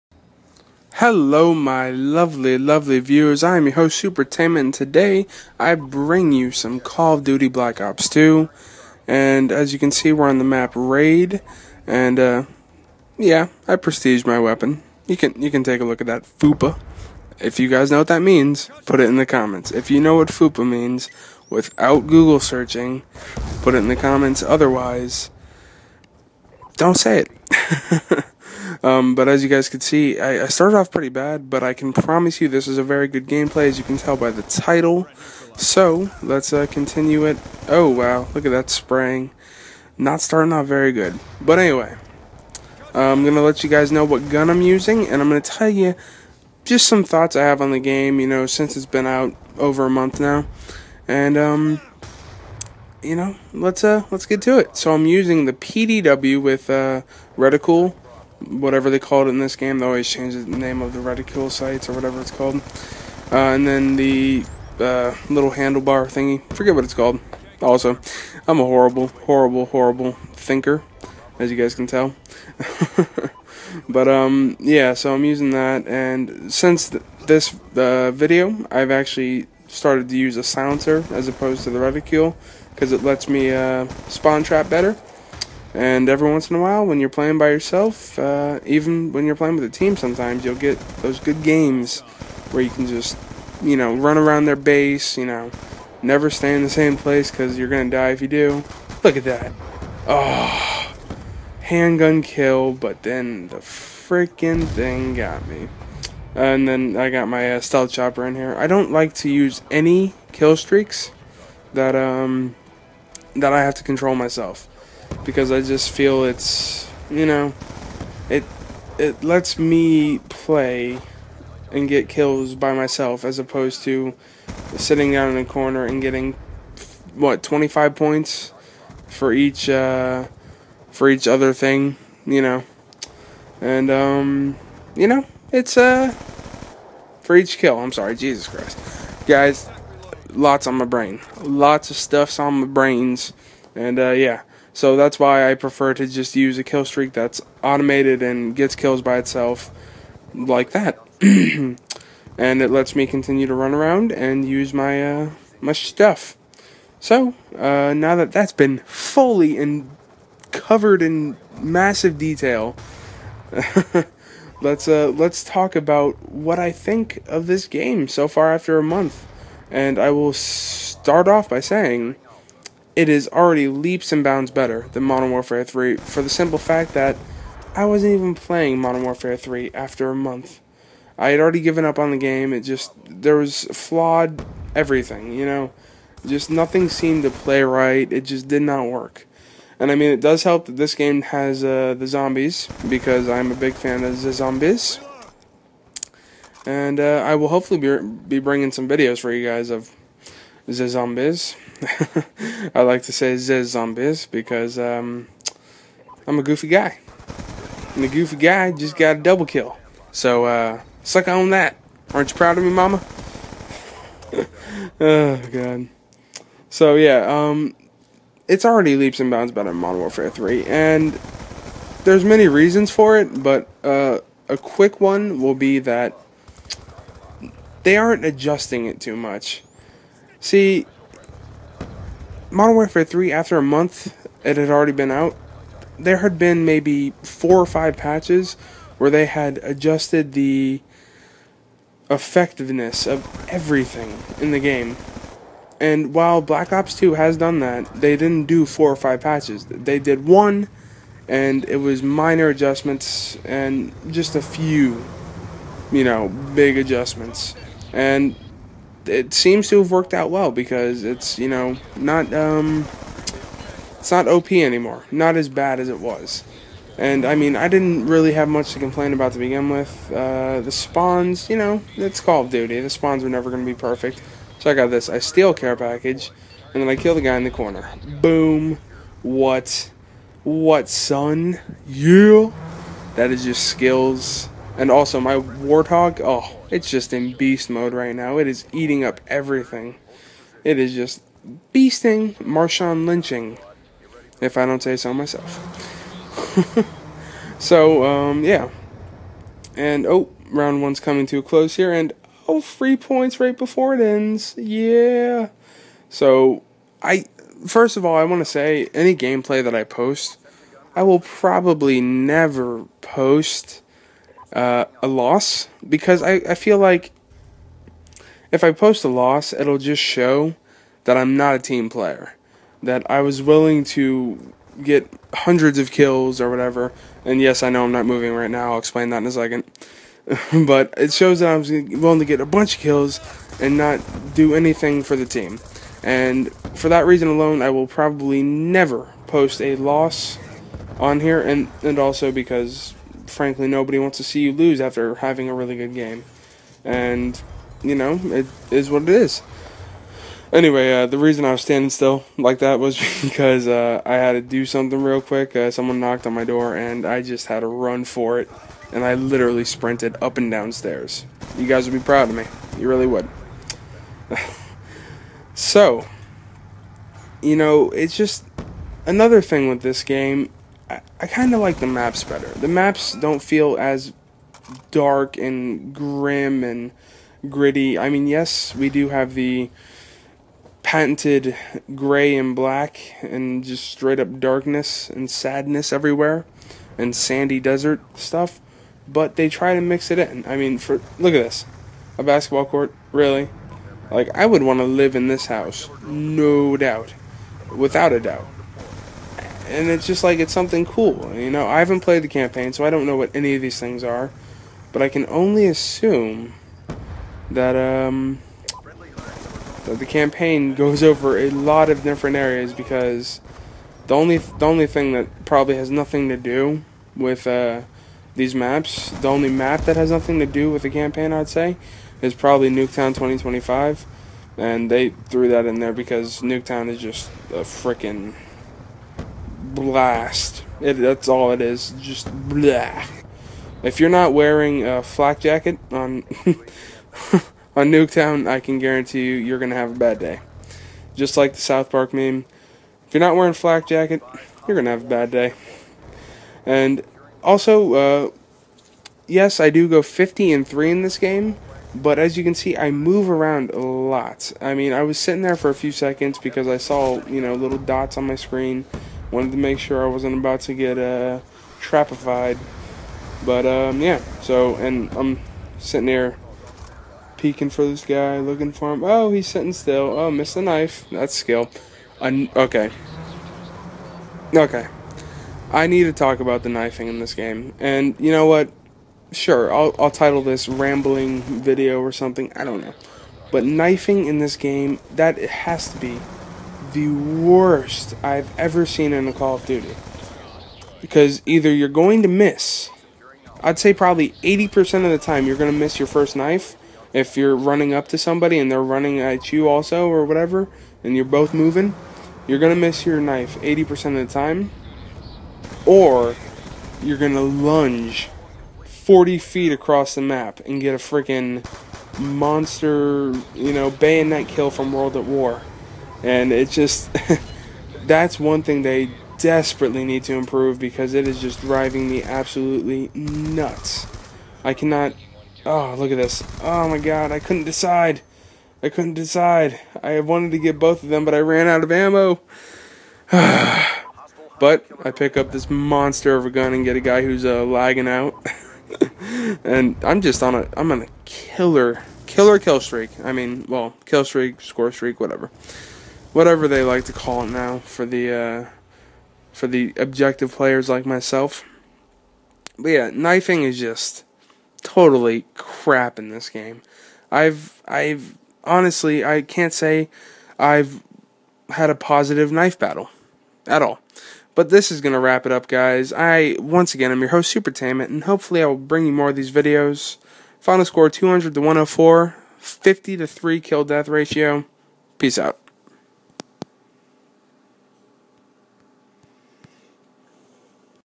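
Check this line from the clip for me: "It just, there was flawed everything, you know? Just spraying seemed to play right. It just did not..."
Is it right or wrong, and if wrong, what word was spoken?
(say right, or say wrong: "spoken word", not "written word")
wrong: "nothing", not "spraying".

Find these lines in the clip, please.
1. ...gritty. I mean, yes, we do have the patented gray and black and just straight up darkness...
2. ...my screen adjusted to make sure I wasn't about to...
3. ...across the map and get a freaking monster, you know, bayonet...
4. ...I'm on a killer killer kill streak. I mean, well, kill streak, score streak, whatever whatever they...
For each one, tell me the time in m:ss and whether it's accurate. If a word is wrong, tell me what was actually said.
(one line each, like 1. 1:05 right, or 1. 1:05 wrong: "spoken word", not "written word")
1. 6:17 right
2. 7:38 wrong: "wanted", not "adjusted"
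3. 8:29 right
4. 9:00 right.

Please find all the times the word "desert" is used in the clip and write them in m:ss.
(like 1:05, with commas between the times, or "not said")
6:27.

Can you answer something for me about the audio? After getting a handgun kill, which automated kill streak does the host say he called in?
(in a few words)
stealth chopper.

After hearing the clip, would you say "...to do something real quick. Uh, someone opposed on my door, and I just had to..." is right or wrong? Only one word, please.
wrong.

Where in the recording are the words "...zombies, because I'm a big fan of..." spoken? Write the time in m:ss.
3:12.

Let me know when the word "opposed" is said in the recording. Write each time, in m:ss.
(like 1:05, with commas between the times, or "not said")
1:21, 2:03.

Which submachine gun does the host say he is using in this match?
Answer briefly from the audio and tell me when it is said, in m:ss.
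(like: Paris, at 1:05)
PDW, at 0:55.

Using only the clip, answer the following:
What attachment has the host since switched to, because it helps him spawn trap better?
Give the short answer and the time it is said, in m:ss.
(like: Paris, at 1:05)
silencer, at 1:20.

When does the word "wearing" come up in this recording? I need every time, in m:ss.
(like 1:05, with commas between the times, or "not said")
7:14, 7:23.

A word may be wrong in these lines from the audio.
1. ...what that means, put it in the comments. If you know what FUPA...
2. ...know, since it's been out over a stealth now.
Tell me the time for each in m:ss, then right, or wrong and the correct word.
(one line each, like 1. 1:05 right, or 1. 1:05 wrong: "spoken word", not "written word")
1. 0:17 right
2. 0:48 wrong: "month", not "stealth".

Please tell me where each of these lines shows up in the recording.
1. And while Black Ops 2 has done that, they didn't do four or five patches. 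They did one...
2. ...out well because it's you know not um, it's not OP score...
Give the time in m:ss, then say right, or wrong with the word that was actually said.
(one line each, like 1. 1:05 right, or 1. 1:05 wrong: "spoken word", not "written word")
1. 4:05 right
2. 4:20 wrong: "anymore", not "score".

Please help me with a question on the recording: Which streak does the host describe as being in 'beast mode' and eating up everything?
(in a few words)
Warthog.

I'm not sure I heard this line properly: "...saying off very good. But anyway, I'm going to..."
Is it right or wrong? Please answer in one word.
wrong.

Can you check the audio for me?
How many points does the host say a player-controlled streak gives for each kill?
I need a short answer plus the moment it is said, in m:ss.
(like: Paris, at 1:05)
25, at 2:07.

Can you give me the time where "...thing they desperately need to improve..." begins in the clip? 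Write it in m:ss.
8:38.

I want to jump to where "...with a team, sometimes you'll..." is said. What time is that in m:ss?
1:29.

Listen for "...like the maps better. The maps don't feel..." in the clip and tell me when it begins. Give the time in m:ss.
6:11.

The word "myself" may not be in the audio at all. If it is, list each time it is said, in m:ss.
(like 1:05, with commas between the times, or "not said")
1:54, 2:02, 4:55, 9:11.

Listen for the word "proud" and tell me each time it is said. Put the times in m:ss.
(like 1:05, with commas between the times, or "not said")
3:32, 6:02.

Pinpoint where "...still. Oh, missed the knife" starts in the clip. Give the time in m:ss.
7:49.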